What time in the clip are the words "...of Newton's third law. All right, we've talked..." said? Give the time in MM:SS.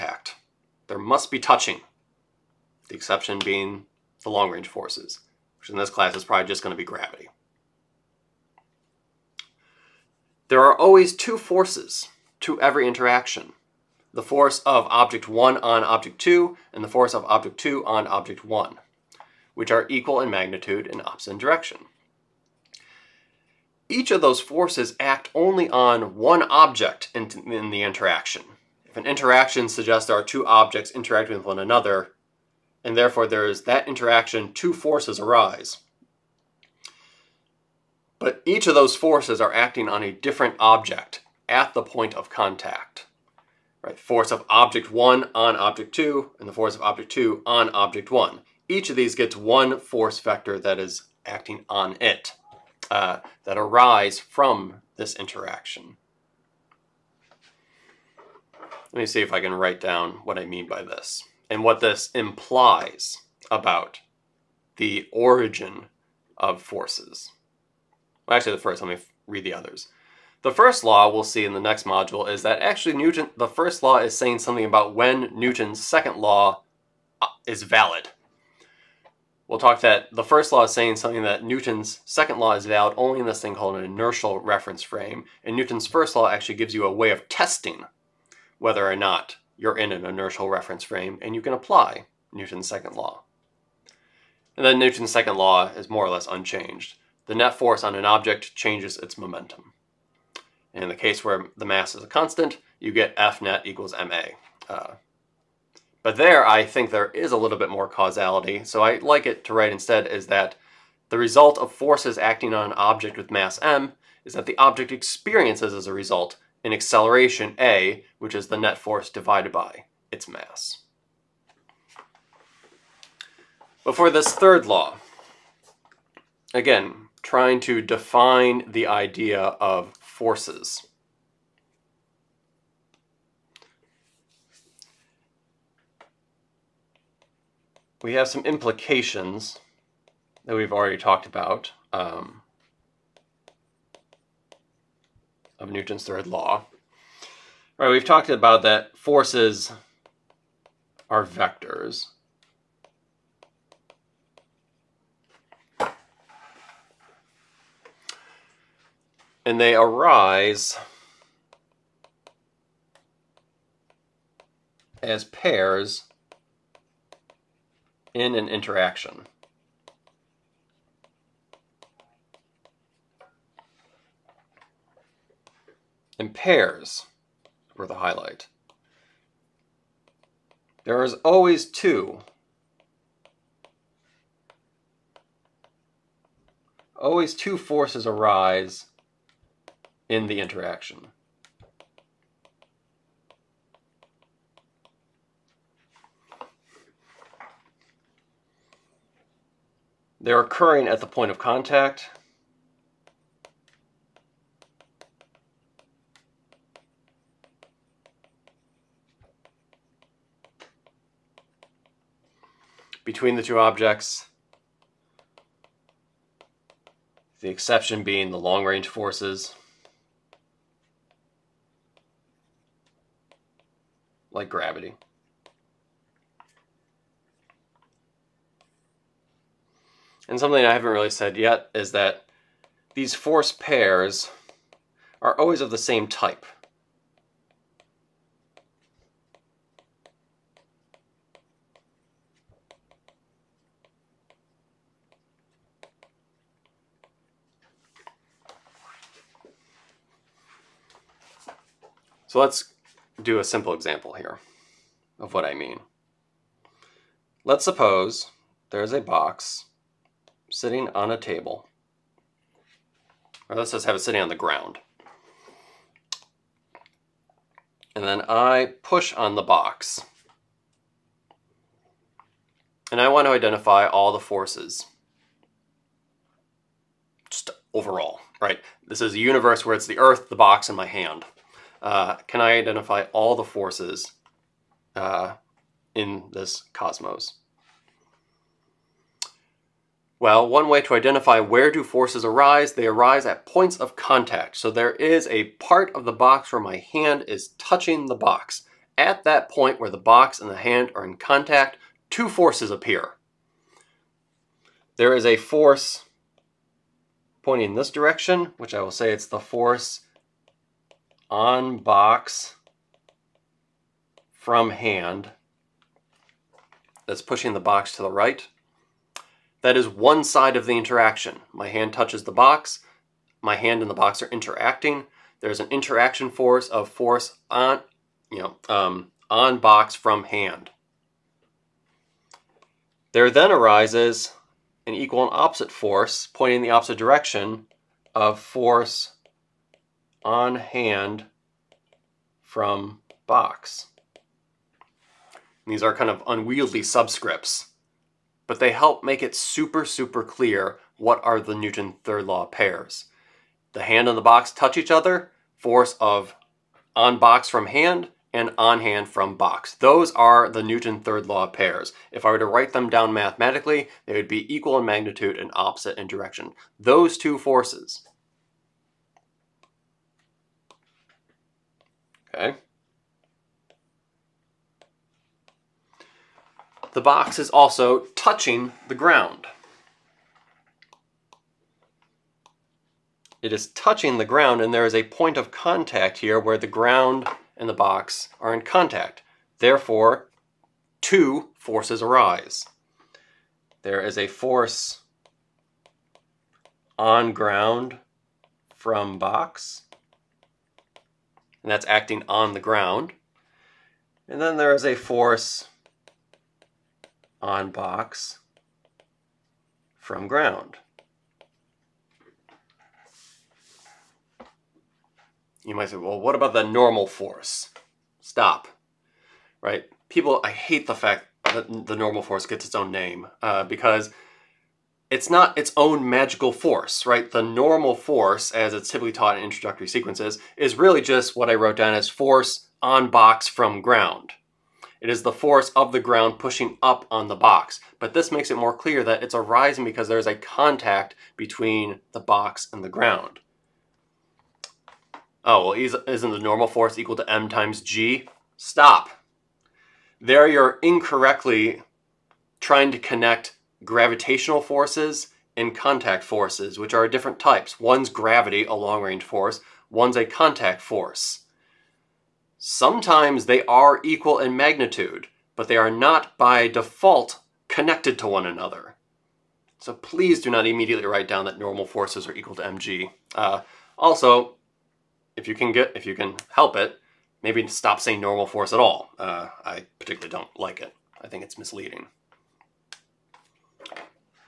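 02:25.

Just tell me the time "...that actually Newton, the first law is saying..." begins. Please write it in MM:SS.
01:12.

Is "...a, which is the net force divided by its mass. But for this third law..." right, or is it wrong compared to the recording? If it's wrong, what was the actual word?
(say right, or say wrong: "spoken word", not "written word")
right.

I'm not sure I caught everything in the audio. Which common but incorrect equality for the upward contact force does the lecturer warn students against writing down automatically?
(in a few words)
Equal to m times g.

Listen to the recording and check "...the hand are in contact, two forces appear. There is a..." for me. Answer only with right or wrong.
right.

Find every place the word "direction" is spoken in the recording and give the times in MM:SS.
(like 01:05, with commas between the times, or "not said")
00:21, 05:07, 05:36, 06:06.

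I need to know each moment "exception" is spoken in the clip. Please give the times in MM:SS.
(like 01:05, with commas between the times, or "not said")
00:02, 03:37.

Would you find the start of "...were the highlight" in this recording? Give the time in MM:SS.
02:57.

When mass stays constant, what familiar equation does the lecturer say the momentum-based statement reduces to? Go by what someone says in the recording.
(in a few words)
F net equals ma.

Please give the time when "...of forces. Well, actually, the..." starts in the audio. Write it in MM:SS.
01:06.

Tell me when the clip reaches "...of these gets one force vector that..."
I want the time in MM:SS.
00:48.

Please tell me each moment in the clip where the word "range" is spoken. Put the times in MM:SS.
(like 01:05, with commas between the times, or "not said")
00:04, 03:38, 07:38.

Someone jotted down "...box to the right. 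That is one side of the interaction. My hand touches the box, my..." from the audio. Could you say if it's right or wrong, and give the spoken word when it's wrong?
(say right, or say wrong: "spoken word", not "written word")
right.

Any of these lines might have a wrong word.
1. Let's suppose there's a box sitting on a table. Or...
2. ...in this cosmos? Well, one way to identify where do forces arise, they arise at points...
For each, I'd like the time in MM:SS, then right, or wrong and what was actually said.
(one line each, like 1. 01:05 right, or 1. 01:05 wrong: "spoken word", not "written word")
1. 04:17 right
2. 04:45 right.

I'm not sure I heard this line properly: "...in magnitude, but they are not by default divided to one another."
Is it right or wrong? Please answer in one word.
wrong.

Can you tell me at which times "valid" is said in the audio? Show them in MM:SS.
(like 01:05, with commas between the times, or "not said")
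01:17, 01:22.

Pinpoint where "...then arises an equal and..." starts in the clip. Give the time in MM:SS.
05:33.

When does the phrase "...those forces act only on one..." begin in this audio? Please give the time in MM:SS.
00:24.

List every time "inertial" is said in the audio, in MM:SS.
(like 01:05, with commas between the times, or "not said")
01:23, 01:30.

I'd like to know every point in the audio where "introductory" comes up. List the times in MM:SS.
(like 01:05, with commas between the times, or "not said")
07:09.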